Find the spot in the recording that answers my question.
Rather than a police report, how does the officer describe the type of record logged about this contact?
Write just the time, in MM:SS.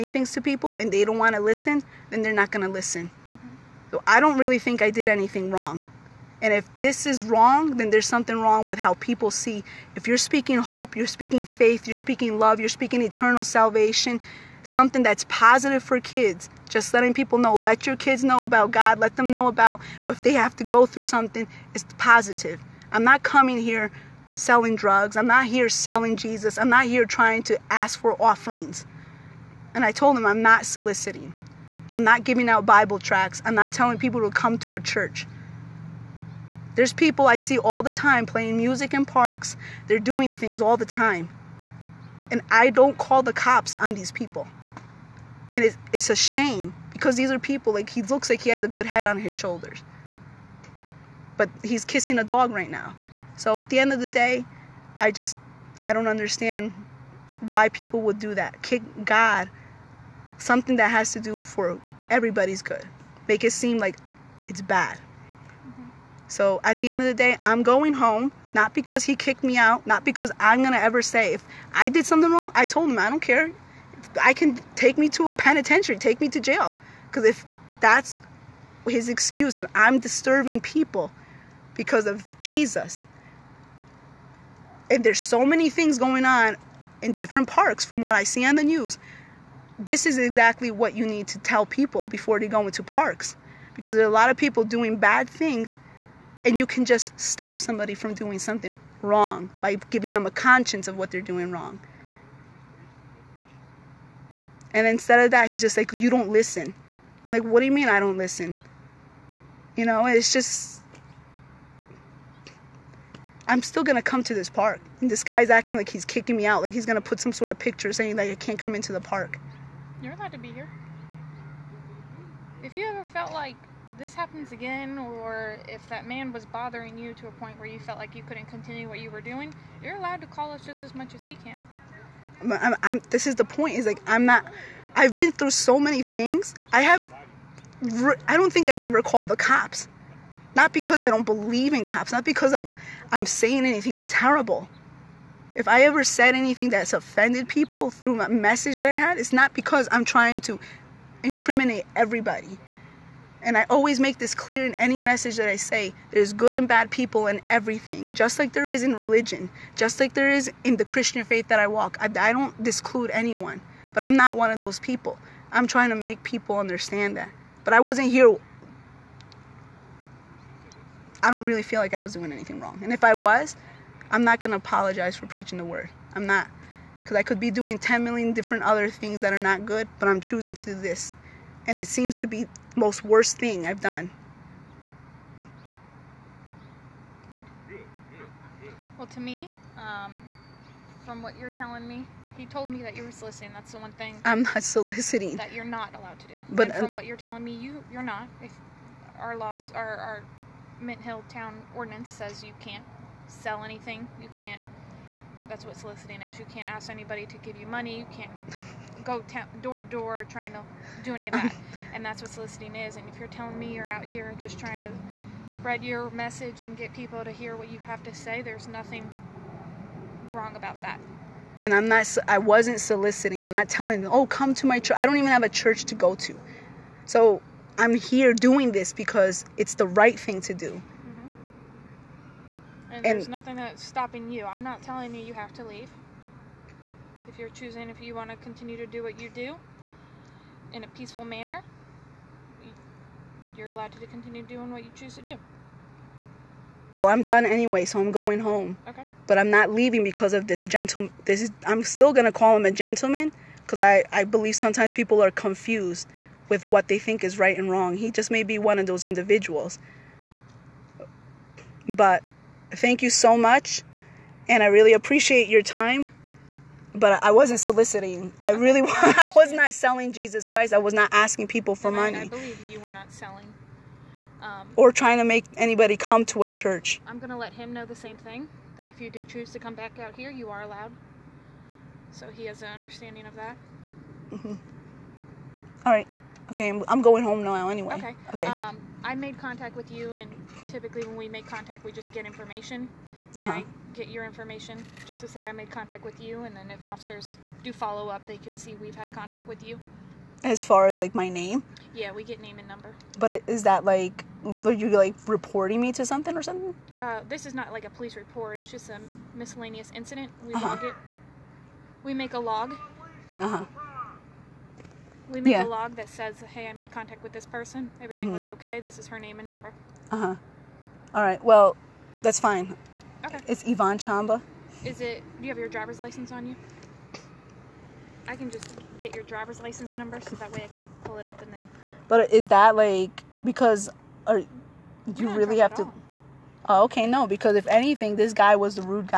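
05:09.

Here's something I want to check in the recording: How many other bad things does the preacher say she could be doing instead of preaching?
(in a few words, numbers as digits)
10 million.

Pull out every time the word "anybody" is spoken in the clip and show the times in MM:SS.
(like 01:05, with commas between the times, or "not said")
03:26, 04:35.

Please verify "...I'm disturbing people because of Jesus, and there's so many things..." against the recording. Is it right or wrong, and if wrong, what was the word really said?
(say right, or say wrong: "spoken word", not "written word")
right.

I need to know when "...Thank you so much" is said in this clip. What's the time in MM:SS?
04:22.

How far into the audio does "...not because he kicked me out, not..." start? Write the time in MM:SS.
01:08.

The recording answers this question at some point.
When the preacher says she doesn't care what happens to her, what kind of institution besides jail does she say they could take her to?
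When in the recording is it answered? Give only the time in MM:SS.
01:15.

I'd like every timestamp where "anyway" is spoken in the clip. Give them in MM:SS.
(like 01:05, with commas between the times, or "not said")
04:07, 04:47.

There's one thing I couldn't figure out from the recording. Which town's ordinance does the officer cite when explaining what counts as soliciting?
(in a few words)
Mint Hill.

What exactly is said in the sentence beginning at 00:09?
If you're speaking hope, you're speaking faith, you're speaking love, you're speaking eternal salvation, something that's positive for kids.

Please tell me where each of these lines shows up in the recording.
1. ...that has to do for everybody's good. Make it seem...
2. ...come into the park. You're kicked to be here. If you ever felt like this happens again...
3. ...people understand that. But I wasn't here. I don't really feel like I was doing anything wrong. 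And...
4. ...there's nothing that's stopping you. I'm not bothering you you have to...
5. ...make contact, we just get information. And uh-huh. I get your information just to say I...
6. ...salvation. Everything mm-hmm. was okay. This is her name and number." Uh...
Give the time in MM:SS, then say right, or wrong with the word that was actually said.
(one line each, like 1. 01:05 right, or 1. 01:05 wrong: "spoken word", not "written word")
1. 01:00 right
2. 01:58 wrong: "allowed", not "kicked"
3. 02:46 right
4. 03:53 wrong: "telling", not "bothering"
5. 04:51 right
6. 05:17 wrong: "person", not "salvation".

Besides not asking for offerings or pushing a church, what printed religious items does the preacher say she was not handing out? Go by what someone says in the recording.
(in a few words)
Bible tracts.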